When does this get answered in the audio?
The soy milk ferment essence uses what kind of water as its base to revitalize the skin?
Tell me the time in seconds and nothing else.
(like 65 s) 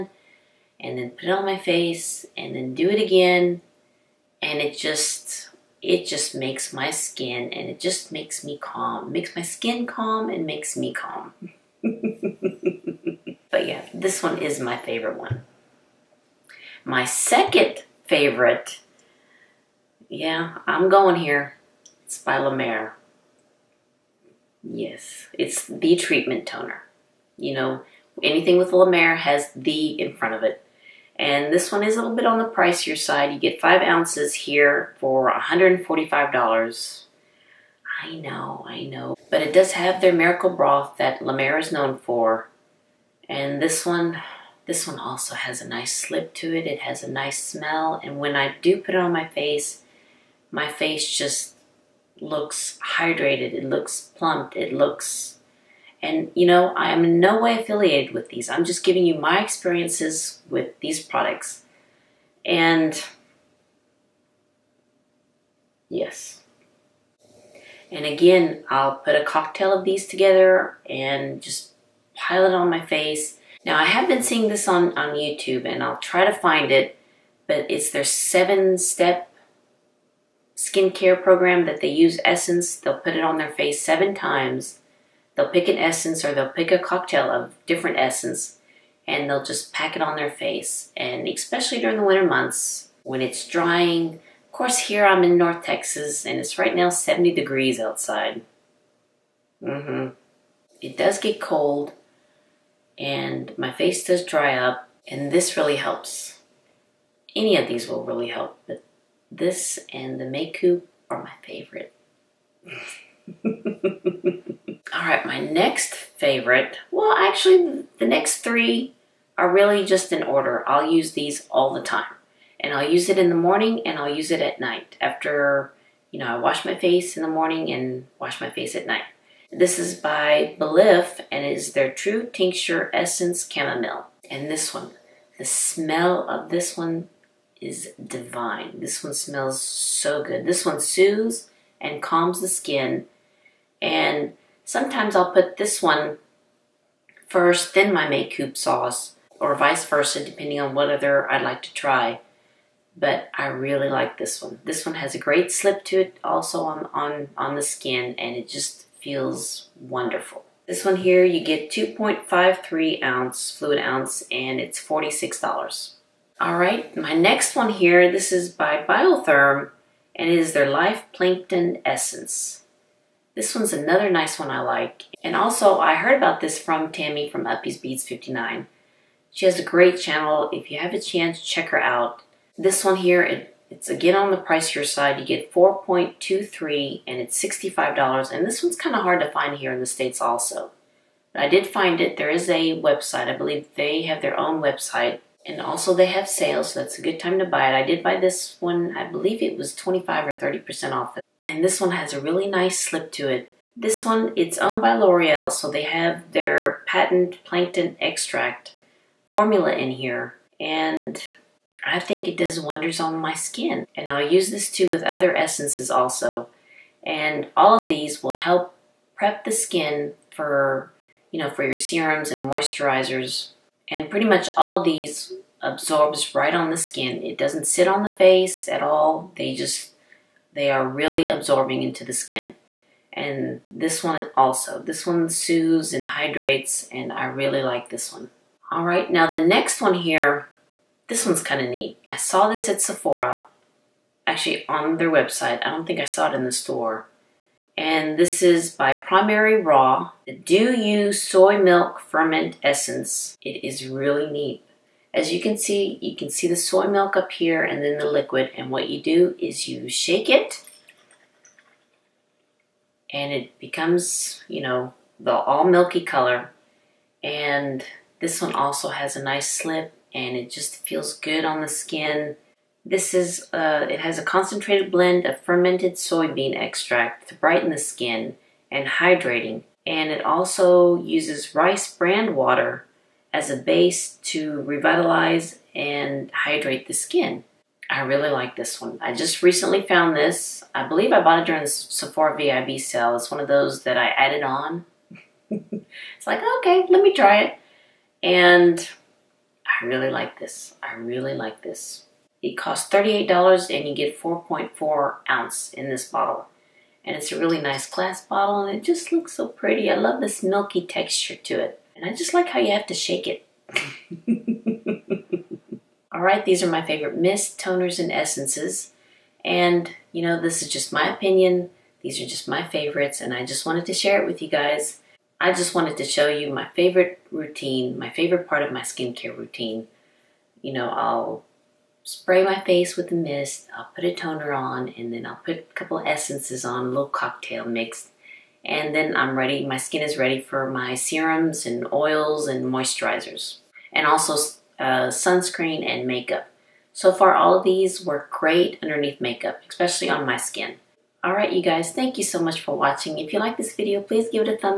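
281 s.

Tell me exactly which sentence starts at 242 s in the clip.
I saw this at Sephora, actually on their website.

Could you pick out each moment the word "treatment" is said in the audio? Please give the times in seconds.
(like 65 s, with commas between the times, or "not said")
25 s.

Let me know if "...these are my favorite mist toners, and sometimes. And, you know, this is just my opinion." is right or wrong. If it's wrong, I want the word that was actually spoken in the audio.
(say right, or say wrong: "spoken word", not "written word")
wrong: "essences", not "sometimes".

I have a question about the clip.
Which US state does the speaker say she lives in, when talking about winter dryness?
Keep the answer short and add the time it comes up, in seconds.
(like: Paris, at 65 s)
Texas, at 95 s.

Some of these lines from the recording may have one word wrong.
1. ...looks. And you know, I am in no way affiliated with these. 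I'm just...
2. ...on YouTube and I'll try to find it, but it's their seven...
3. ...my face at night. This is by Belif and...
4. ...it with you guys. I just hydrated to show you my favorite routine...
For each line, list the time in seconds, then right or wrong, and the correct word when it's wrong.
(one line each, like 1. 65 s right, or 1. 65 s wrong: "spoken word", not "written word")
1. 54 s right
2. 74 s right
3. 128 s right
4. 324 s wrong: "wanted", not "hydrated".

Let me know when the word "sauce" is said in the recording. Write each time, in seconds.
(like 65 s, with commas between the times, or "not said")
148 s.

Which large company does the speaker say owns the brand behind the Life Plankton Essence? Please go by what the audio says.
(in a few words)
L'Oreal.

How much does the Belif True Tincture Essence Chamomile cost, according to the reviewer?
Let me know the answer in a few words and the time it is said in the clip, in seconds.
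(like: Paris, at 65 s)
$46, at 164 s.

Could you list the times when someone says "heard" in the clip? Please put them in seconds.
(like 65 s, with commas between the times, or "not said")
175 s.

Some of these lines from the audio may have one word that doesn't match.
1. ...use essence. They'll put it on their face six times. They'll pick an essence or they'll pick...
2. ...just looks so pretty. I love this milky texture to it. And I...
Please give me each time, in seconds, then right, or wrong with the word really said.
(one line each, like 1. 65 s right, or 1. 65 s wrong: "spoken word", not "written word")
1. 81 s wrong: "seven", not "six"
2. 308 s right.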